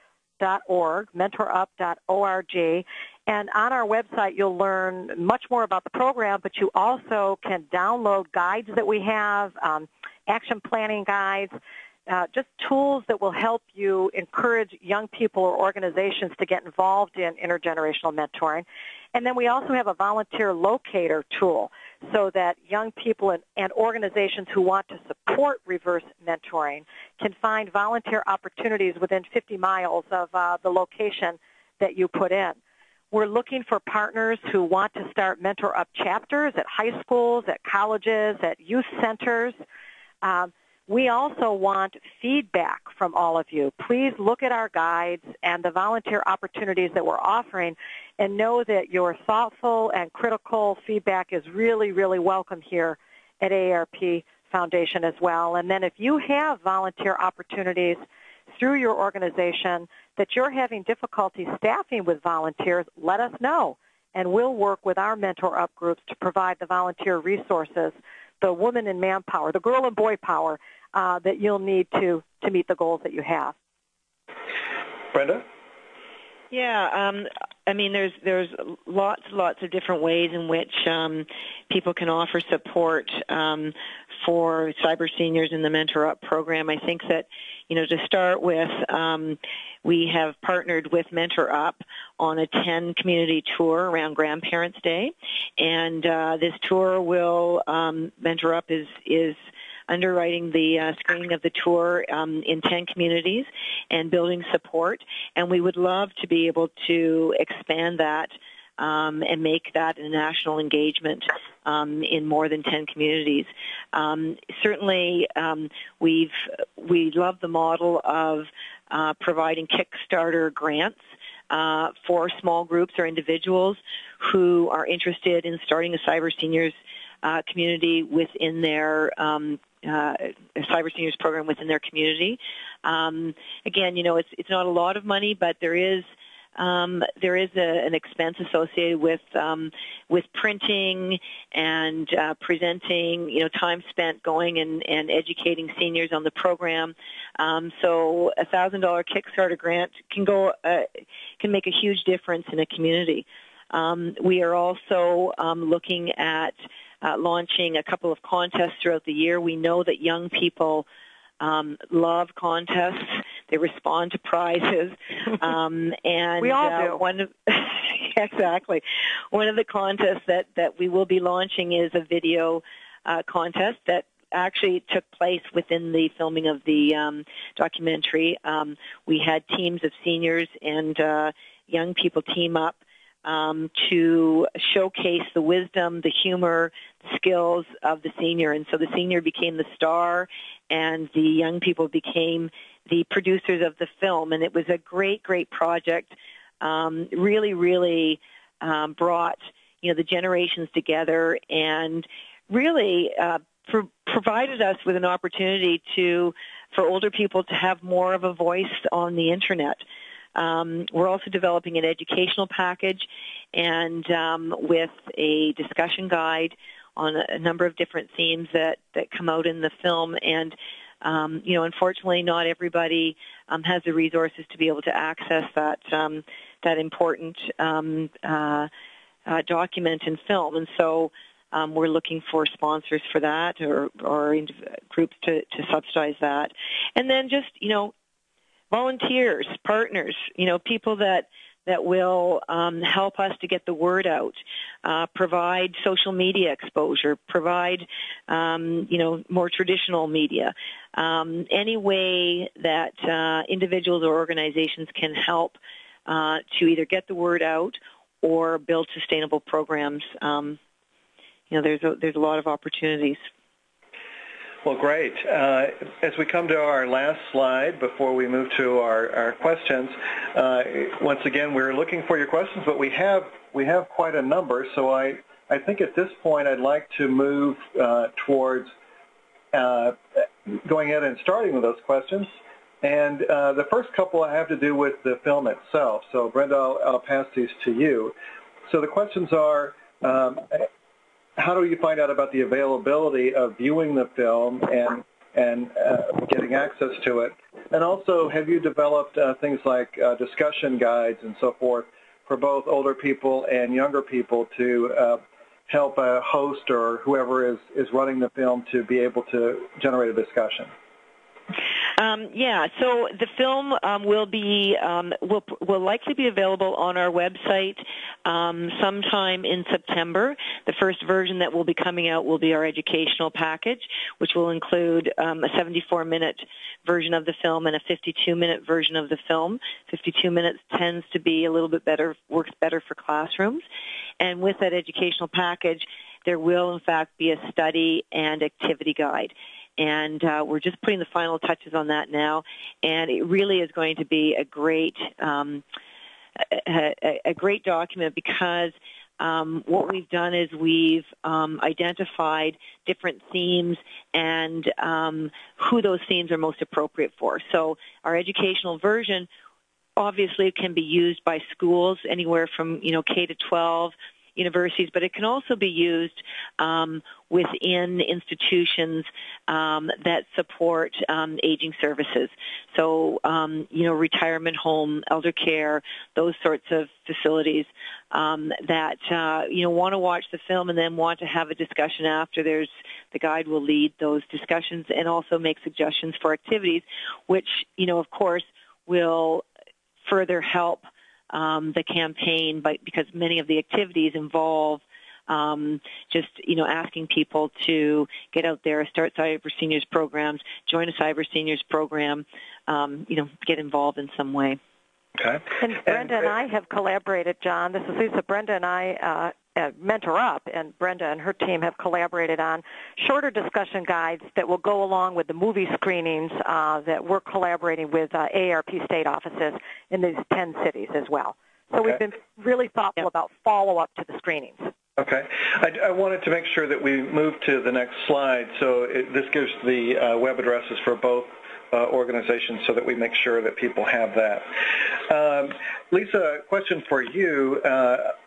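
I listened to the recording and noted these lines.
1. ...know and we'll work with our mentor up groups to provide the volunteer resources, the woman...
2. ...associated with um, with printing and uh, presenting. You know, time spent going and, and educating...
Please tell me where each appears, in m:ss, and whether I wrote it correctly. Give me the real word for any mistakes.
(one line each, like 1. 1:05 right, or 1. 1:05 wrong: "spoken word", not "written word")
1. 1:03 right
2. 2:18 right.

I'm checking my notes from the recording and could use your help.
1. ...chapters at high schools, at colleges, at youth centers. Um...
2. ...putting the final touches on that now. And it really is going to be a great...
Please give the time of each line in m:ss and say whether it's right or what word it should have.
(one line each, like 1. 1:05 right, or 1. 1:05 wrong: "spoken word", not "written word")
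1. 0:35 right
2. 5:40 right.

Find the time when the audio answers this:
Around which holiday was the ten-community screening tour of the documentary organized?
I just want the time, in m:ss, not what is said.
1:34.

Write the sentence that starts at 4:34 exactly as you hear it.
So I, I think at this point, I'd like to move uh, towards uh, going ahead and starting with those questions.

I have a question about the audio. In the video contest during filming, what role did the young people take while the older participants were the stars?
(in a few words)
producers.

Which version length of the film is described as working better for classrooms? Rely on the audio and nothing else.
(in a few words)
52 minutes.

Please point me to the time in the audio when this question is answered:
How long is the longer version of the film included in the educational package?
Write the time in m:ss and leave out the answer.
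5:25.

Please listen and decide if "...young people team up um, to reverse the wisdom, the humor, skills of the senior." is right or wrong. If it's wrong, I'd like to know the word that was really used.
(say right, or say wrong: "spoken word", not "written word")
wrong: "showcase", not "reverse".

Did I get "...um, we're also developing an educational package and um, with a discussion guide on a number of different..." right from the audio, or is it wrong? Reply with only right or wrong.
right.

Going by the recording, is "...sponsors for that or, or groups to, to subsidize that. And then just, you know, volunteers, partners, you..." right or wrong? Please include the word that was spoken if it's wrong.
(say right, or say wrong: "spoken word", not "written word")
right.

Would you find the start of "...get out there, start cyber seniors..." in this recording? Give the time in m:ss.
6:38.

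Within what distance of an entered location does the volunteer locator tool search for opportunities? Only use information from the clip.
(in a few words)
50 miles.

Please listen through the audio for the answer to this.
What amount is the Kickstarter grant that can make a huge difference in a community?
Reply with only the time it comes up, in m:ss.
2:28.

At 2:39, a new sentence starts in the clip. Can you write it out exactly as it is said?
We know that young people um, love contests.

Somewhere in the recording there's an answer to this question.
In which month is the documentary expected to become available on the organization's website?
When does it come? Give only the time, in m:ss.
5:19.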